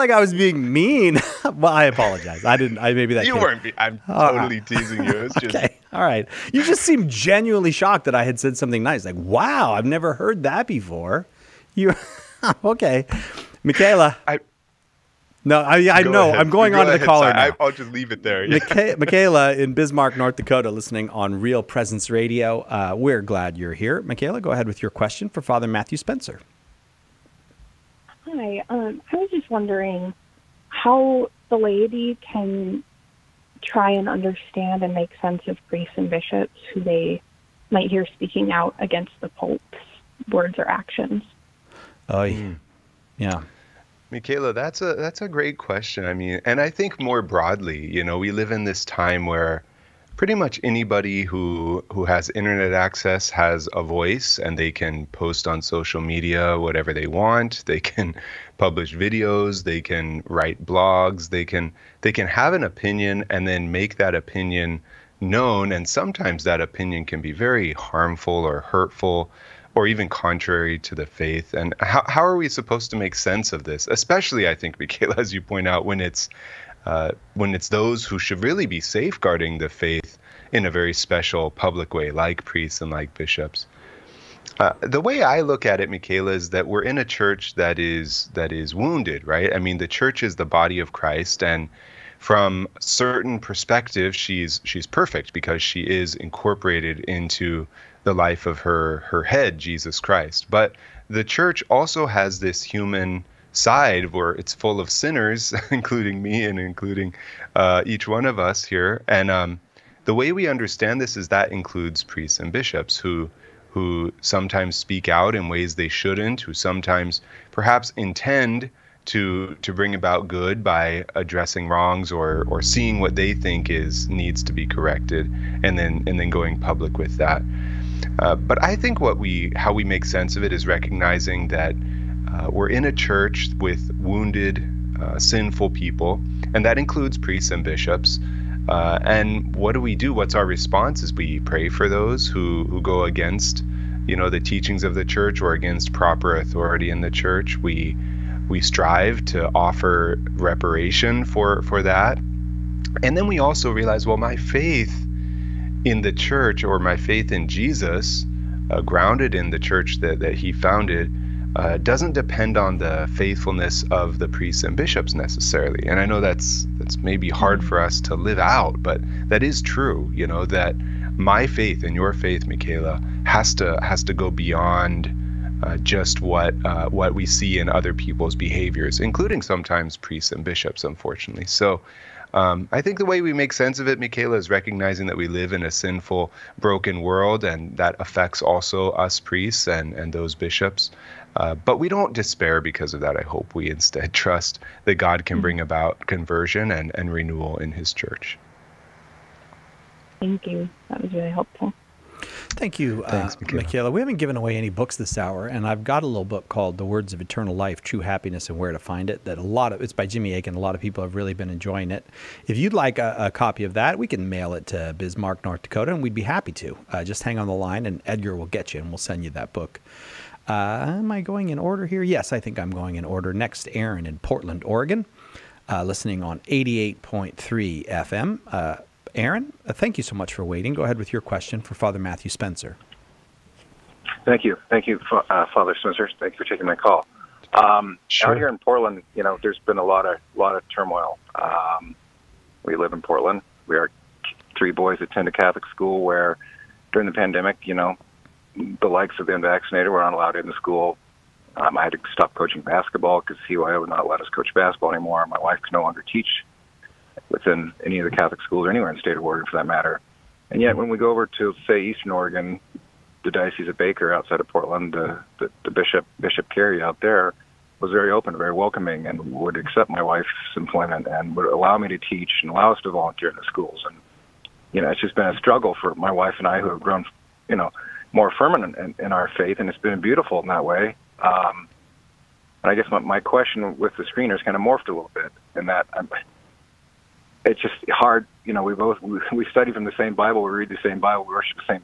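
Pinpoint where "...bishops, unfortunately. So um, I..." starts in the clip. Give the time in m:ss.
3:00.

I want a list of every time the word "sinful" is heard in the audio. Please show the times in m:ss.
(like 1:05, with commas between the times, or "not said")
2:15, 3:05.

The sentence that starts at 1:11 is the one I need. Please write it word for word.
And how, how are we supposed to make sense of this?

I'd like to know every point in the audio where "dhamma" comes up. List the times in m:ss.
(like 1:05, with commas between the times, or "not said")
not said.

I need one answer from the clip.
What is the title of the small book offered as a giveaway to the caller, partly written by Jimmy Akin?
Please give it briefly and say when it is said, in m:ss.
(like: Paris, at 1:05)
The Words of Eternal Life, at 3:26.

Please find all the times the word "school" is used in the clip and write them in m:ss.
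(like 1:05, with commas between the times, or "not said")
4:05, 4:10, 4:18, 4:33.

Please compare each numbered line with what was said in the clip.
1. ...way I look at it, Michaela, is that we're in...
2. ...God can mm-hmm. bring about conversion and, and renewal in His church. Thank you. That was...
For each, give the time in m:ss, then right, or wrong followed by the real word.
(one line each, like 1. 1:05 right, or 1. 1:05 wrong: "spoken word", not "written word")
1. 1:25 right
2. 3:14 right.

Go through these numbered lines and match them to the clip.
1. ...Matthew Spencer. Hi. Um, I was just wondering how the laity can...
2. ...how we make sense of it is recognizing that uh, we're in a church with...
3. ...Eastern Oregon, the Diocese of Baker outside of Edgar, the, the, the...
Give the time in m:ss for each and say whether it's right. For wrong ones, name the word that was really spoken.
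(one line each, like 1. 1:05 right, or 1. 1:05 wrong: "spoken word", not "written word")
1. 0:25 right
2. 2:09 right
3. 4:21 wrong: "Portland", not "Edgar".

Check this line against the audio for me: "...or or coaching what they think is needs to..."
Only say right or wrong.
wrong.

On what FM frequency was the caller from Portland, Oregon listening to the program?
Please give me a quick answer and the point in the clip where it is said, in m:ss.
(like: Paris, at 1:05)
88.3 FM, at 3:46.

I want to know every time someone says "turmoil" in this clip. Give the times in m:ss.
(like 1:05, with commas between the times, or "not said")
4:00.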